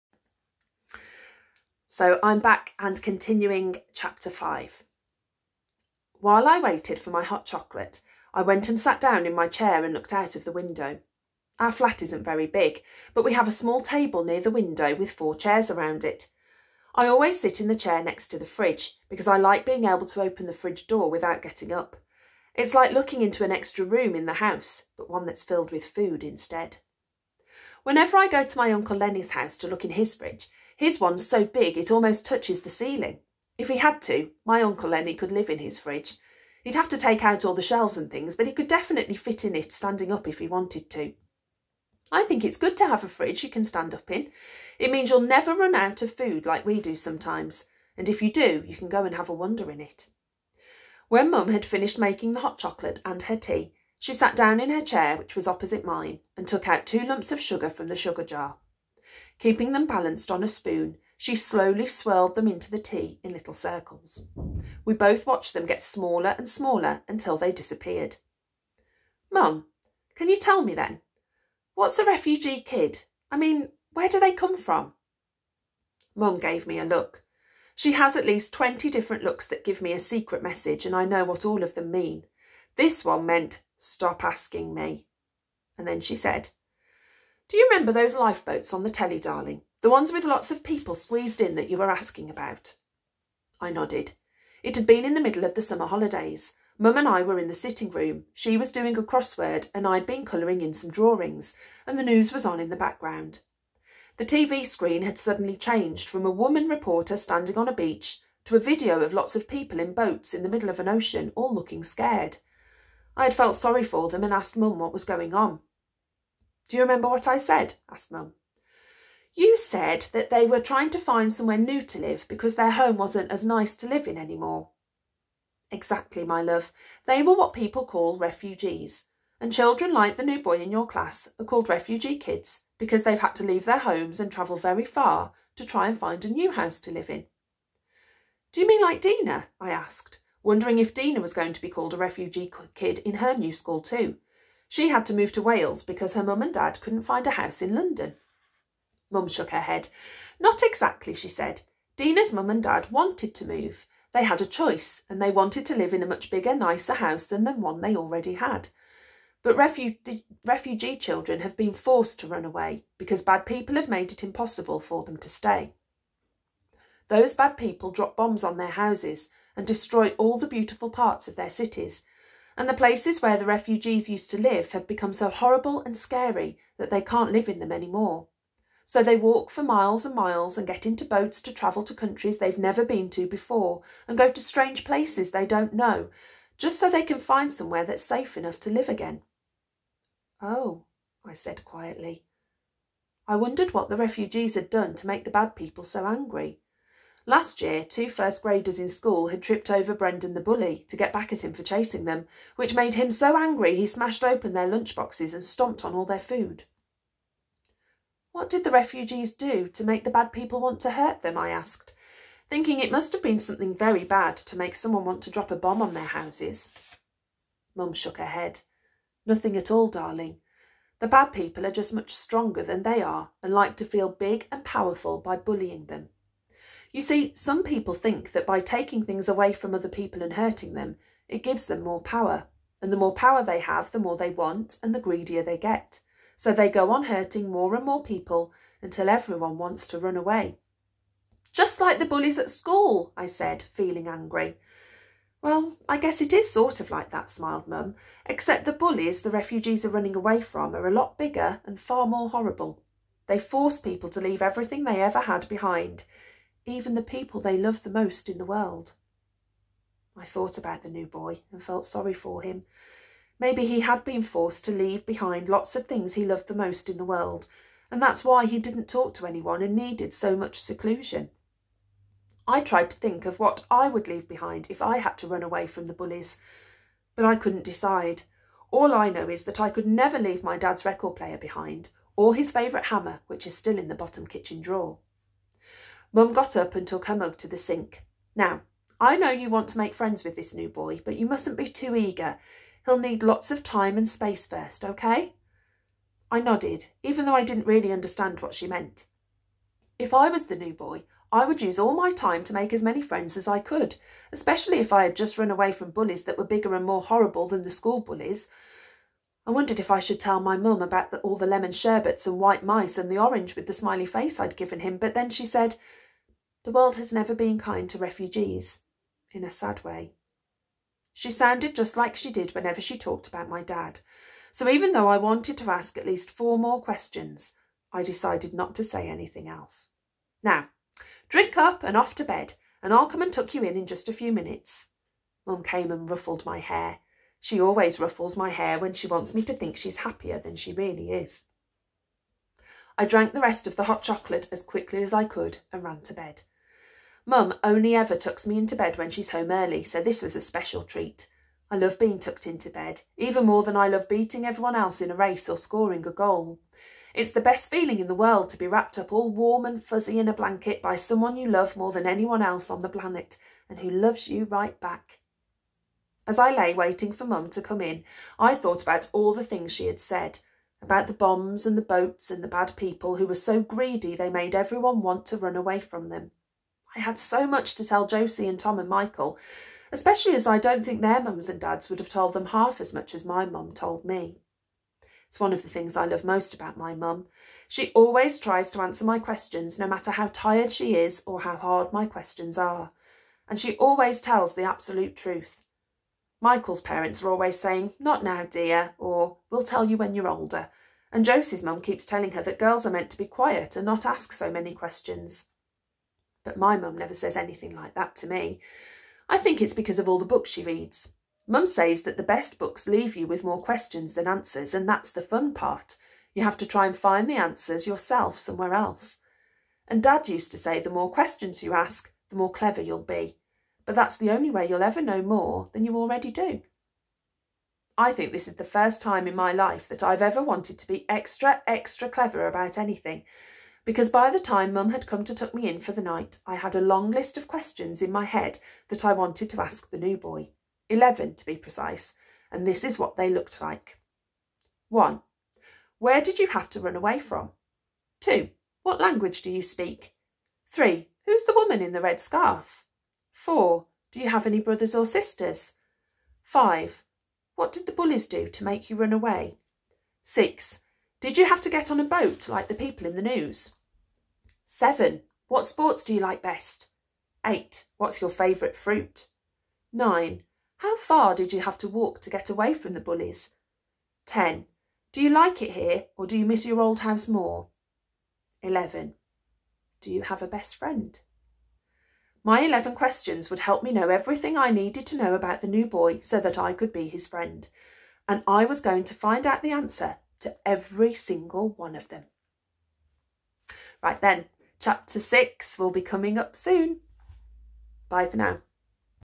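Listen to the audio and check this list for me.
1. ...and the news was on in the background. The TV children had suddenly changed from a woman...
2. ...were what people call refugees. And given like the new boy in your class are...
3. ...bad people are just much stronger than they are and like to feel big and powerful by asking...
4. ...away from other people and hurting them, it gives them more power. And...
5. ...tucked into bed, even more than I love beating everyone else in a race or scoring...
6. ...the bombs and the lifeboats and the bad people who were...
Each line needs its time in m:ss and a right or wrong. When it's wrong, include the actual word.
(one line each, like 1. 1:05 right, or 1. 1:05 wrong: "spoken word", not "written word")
1. 1:41 wrong: "screen", not "children"
2. 2:07 wrong: "children", not "given"
3. 3:41 wrong: "bullying", not "asking"
4. 3:49 right
5. 5:52 right
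6. 6:11 wrong: "boats", not "lifeboats".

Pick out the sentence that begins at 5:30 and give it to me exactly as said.
Now, drink up and off to bed, and I'll come and tuck you in in just a few minutes.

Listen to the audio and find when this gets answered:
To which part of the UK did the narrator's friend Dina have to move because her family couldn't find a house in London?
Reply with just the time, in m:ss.
2:25.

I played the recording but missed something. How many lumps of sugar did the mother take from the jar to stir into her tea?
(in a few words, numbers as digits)
2.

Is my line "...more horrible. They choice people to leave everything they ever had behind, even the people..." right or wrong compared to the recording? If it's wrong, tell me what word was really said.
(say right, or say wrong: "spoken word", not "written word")
wrong: "force", not "choice".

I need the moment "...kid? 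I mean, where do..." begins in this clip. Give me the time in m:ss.
1:12.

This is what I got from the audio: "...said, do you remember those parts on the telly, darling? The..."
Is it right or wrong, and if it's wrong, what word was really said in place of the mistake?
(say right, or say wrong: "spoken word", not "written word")
wrong: "lifeboats", not "parts".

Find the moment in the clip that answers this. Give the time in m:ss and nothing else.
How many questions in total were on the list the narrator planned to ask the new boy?
7:20.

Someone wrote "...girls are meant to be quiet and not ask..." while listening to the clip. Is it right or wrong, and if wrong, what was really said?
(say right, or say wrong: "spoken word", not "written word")
right.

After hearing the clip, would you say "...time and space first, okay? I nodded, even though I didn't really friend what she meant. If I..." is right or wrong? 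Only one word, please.
wrong.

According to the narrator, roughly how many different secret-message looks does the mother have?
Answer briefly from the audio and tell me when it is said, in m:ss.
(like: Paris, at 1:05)
20, at 1:18.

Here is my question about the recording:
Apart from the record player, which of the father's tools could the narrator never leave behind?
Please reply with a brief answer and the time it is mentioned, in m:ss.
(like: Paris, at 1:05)
his favourite hammer, at 4:42.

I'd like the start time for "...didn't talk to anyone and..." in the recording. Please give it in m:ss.
4:28.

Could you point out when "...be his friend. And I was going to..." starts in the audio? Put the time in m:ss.
8:06.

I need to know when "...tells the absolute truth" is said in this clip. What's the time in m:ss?
6:34.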